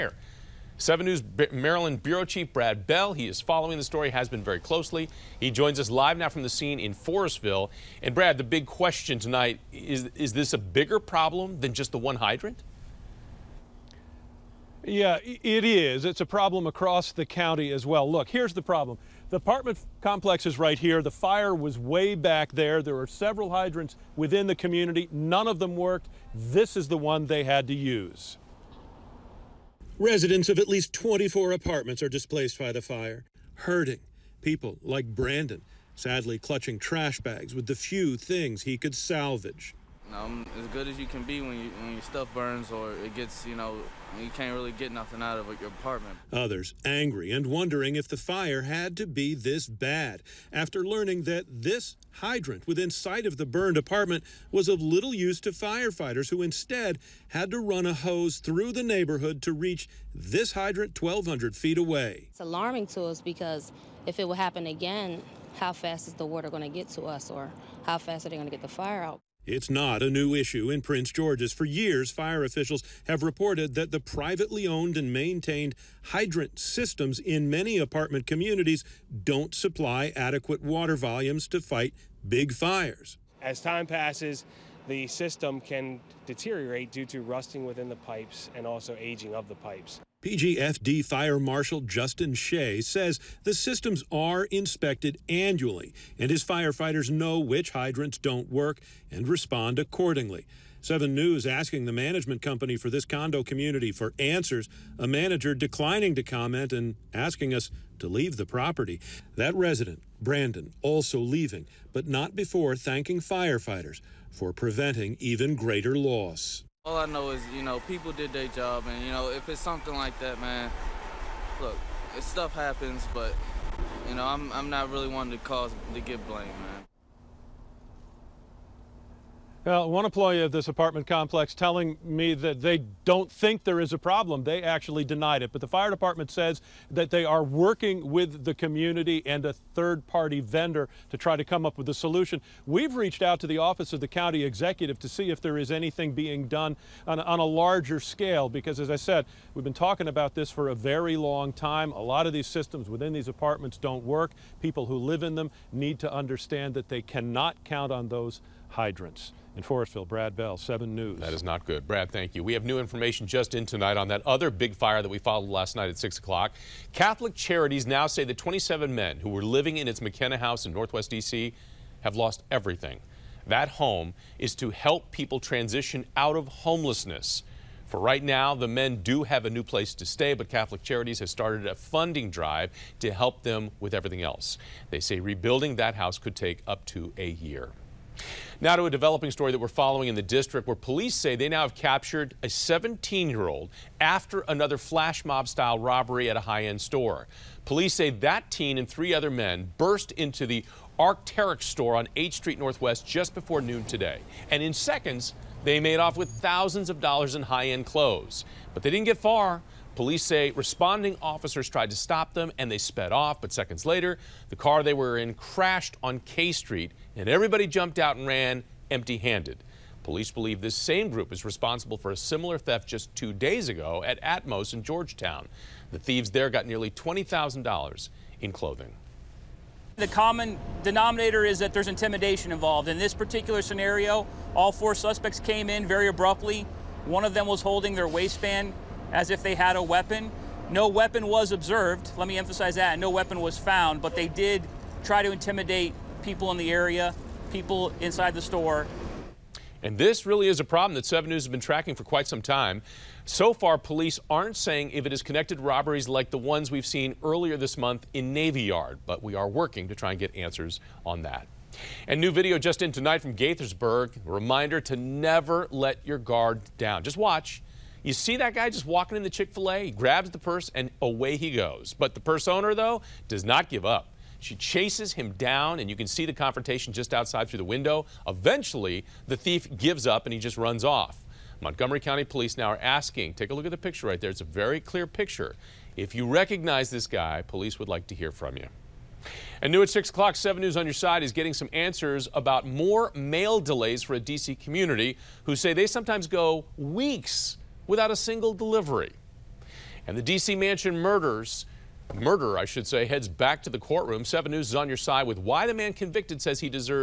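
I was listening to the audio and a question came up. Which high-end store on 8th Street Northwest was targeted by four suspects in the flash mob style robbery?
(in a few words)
Arc'teryx.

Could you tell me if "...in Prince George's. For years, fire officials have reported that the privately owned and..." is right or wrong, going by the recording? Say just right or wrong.
right.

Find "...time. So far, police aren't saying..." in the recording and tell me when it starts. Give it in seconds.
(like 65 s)
252 s.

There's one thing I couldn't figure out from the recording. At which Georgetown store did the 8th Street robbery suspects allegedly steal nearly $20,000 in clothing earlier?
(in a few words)
Atmos.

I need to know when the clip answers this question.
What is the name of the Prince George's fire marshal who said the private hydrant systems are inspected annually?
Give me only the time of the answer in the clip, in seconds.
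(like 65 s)
91 s.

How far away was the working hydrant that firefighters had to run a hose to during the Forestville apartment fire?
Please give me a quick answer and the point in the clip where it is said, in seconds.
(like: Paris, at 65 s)
1,200 feet, at 61 s.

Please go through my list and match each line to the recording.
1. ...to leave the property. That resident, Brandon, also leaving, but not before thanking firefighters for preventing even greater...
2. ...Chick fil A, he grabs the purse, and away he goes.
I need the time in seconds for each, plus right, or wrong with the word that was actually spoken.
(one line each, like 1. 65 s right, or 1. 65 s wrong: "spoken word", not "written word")
1. 108 s right
2. 269 s right.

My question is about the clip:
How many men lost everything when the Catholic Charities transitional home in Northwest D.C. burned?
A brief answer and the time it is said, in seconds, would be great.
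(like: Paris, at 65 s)
27, at 168 s.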